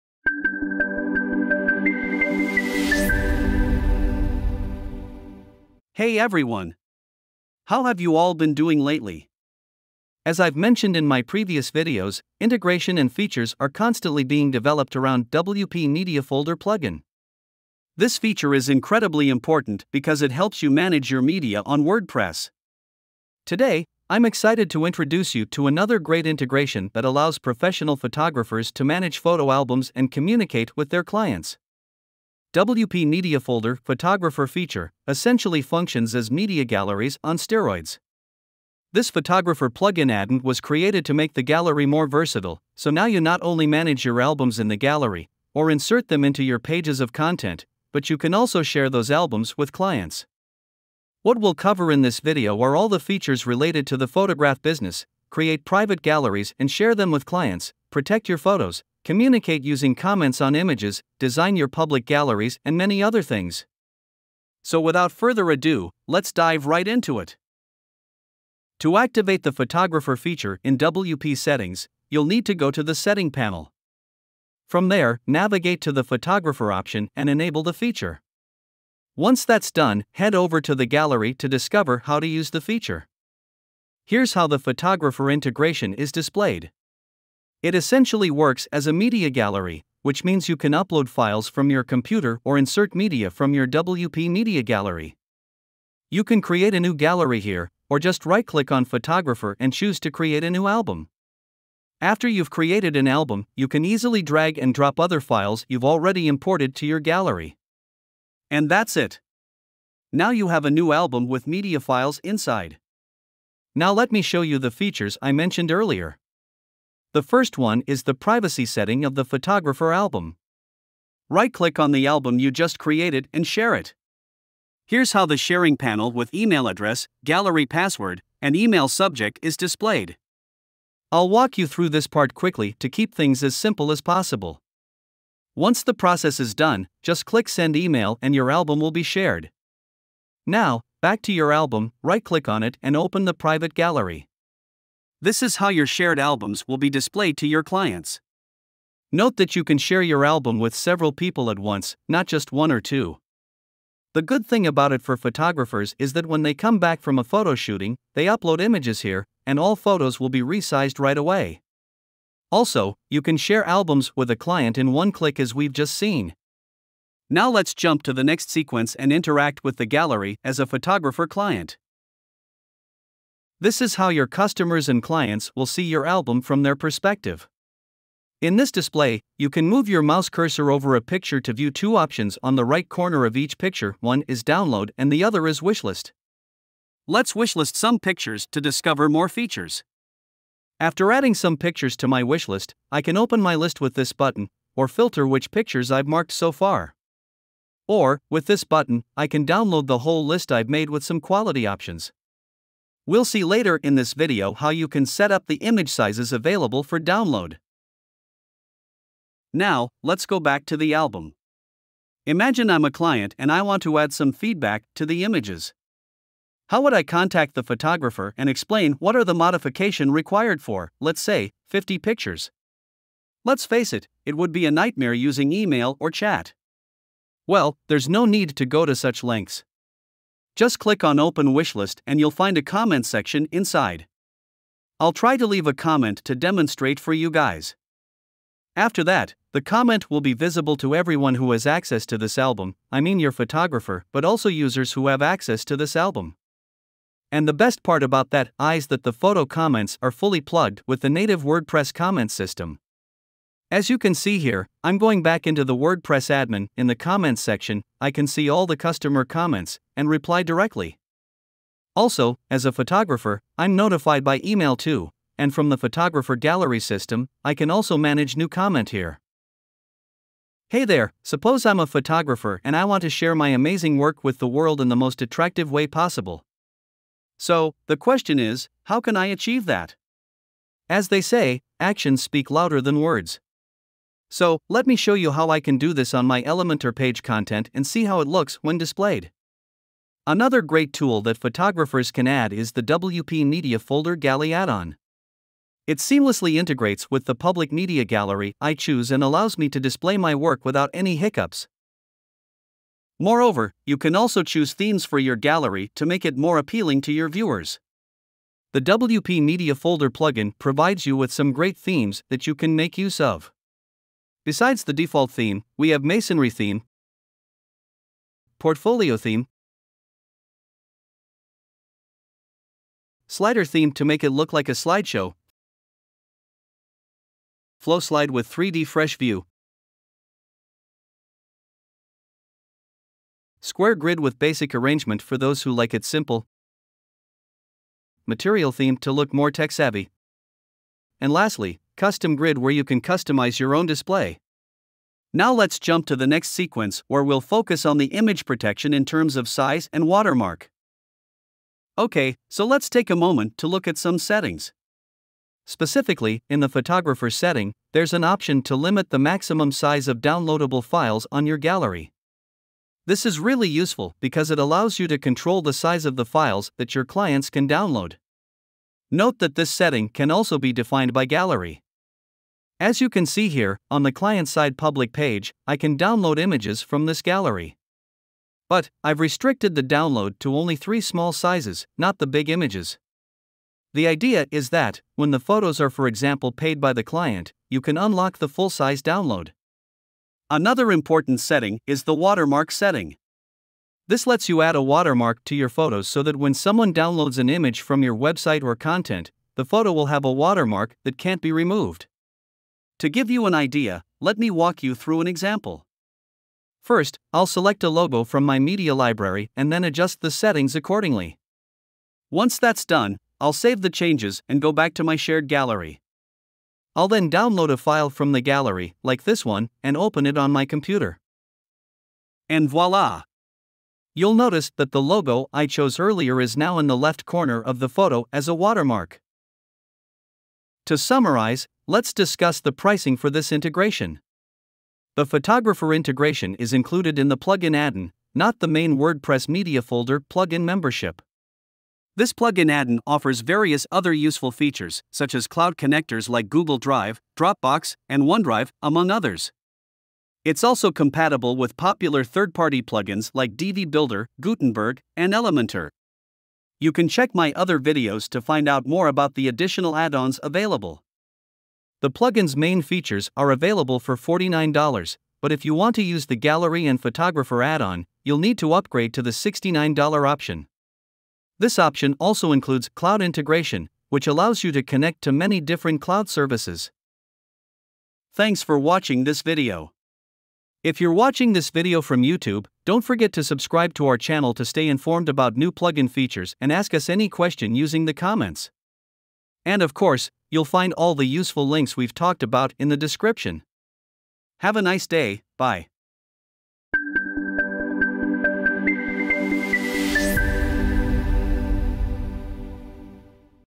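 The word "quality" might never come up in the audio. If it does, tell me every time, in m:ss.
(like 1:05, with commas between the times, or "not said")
3:21.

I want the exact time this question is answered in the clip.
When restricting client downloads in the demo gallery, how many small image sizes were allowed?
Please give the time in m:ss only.
6:20.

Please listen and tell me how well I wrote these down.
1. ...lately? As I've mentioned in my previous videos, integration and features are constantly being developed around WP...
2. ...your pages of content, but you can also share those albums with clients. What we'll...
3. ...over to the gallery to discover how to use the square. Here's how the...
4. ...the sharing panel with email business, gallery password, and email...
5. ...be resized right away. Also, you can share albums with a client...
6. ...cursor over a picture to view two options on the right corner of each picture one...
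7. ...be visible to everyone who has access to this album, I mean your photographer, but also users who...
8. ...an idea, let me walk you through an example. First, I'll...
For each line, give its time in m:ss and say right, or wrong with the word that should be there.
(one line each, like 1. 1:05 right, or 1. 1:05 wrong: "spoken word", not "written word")
1. 0:08 right
2. 0:46 right
3. 1:20 wrong: "feature", not "square"
4. 2:05 wrong: "address", not "business"
5. 2:40 right
6. 3:00 right
7. 4:00 right
8. 6:43 right.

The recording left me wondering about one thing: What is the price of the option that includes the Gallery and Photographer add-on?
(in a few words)
$69.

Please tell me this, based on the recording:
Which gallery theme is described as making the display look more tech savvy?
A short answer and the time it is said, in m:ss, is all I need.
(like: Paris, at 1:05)
material theme, at 5:38.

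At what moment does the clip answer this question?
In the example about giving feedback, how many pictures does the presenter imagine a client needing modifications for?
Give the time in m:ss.
3:41.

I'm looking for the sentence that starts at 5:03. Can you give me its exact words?
Moreover, you can also choose themes for your gallery to make it more appealing to your viewers.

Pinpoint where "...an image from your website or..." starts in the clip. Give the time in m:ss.
6:37.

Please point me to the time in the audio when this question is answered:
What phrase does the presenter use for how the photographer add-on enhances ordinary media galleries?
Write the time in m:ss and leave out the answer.
0:36.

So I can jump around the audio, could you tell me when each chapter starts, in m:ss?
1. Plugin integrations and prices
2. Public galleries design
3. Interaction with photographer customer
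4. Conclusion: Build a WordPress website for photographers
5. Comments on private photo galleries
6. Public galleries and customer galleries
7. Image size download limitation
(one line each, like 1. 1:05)
1. 7:11
2. 4:30
3. 2:54
4. 7:58
5. 3:31
6. 1:09
7. 5:52.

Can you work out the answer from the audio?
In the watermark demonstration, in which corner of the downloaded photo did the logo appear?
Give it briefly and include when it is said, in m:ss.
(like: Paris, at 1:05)
left corner, at 7:06.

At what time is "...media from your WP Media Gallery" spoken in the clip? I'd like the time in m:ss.
1:32.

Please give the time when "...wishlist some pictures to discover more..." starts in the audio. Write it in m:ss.
3:07.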